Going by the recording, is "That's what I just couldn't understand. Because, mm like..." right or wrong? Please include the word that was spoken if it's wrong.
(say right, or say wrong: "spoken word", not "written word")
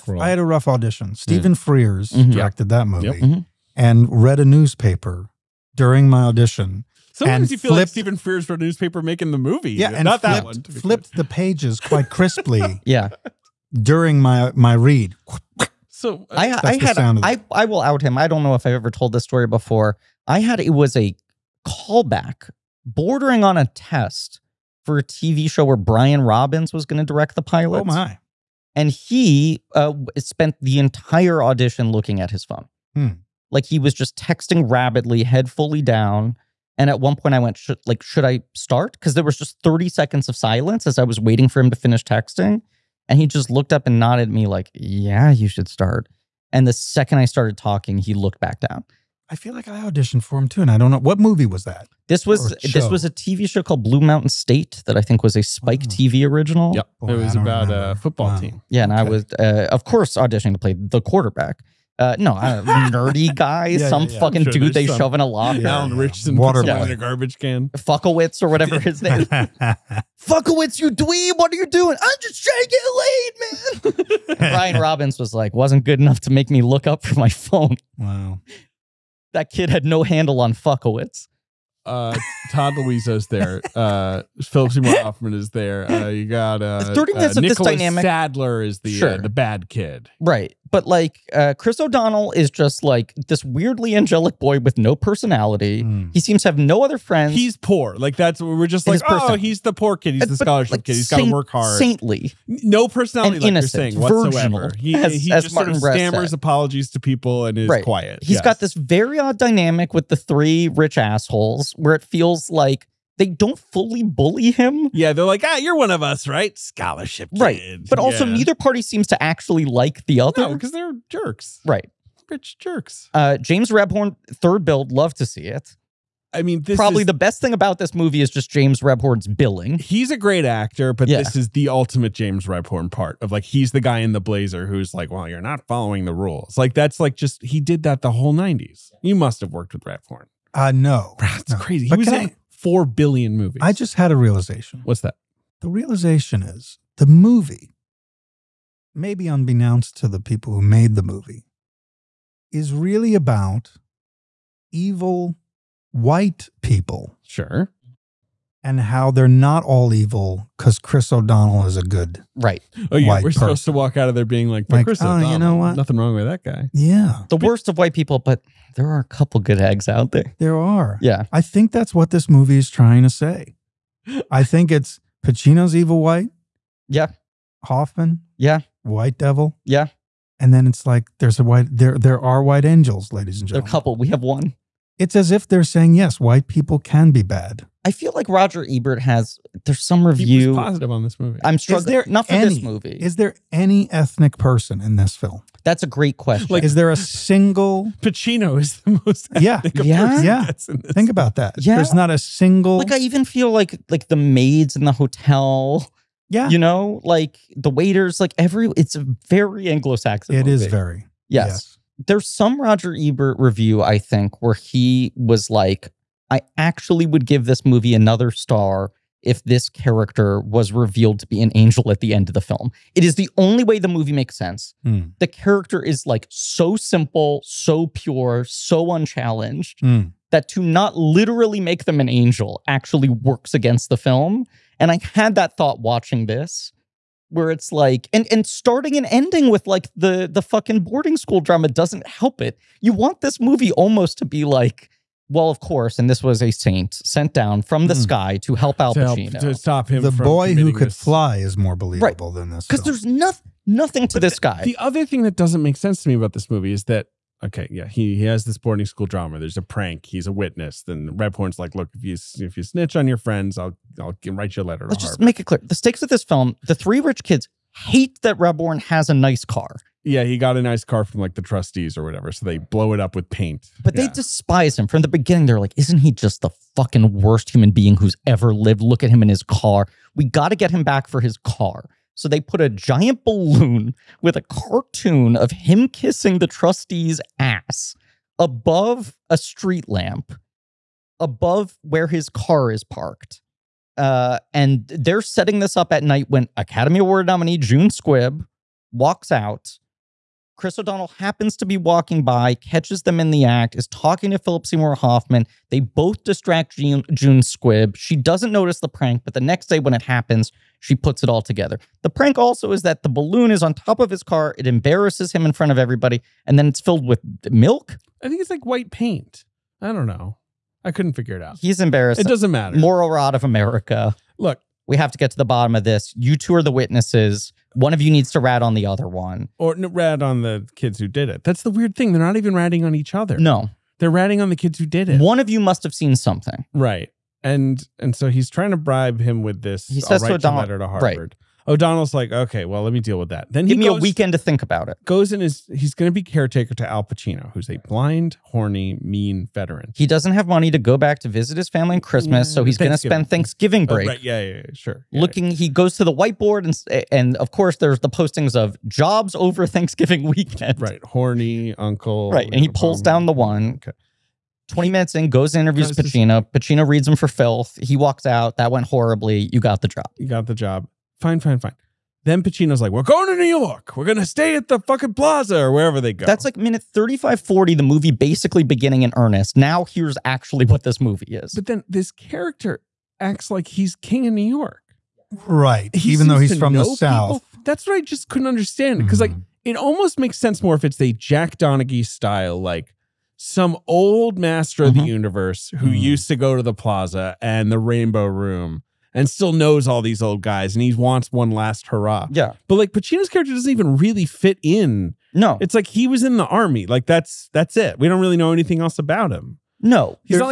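right.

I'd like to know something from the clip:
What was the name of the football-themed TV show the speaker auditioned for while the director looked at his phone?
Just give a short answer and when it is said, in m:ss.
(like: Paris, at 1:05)
Blue Mountain State, at 0:53.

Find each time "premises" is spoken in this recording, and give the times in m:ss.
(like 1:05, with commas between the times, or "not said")
not said.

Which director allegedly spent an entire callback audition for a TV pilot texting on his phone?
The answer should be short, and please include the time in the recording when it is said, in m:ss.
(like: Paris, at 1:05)
Brian Robbins, at 0:25.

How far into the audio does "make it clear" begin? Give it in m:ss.
4:25.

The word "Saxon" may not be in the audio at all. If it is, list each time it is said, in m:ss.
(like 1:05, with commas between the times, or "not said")
3:29.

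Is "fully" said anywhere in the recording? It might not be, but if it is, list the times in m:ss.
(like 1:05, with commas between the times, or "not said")
0:35, 1:53.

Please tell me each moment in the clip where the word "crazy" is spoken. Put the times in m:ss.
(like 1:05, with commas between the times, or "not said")
2:21.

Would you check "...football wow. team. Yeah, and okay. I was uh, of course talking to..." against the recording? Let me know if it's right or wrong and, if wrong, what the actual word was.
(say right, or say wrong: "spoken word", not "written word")
wrong: "auditioning", not "talking".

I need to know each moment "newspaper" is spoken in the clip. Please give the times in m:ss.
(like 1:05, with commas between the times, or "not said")
0:04, 0:08.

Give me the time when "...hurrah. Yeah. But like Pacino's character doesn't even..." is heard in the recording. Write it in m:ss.
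6:41.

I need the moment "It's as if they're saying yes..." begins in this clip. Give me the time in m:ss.
3:04.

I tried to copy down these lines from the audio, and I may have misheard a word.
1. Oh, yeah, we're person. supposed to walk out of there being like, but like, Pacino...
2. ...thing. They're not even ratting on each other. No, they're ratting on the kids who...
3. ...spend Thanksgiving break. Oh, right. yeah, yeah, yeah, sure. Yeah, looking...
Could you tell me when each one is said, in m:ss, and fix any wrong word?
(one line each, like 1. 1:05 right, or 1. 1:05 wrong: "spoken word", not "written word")
1. 2:42 wrong: "Chris", not "Pacino"
2. 5:31 right
3. 5:52 right.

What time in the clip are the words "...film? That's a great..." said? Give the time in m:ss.
3:15.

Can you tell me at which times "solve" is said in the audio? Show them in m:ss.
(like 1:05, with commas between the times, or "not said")
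not said.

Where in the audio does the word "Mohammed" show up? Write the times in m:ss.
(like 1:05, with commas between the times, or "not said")
not said.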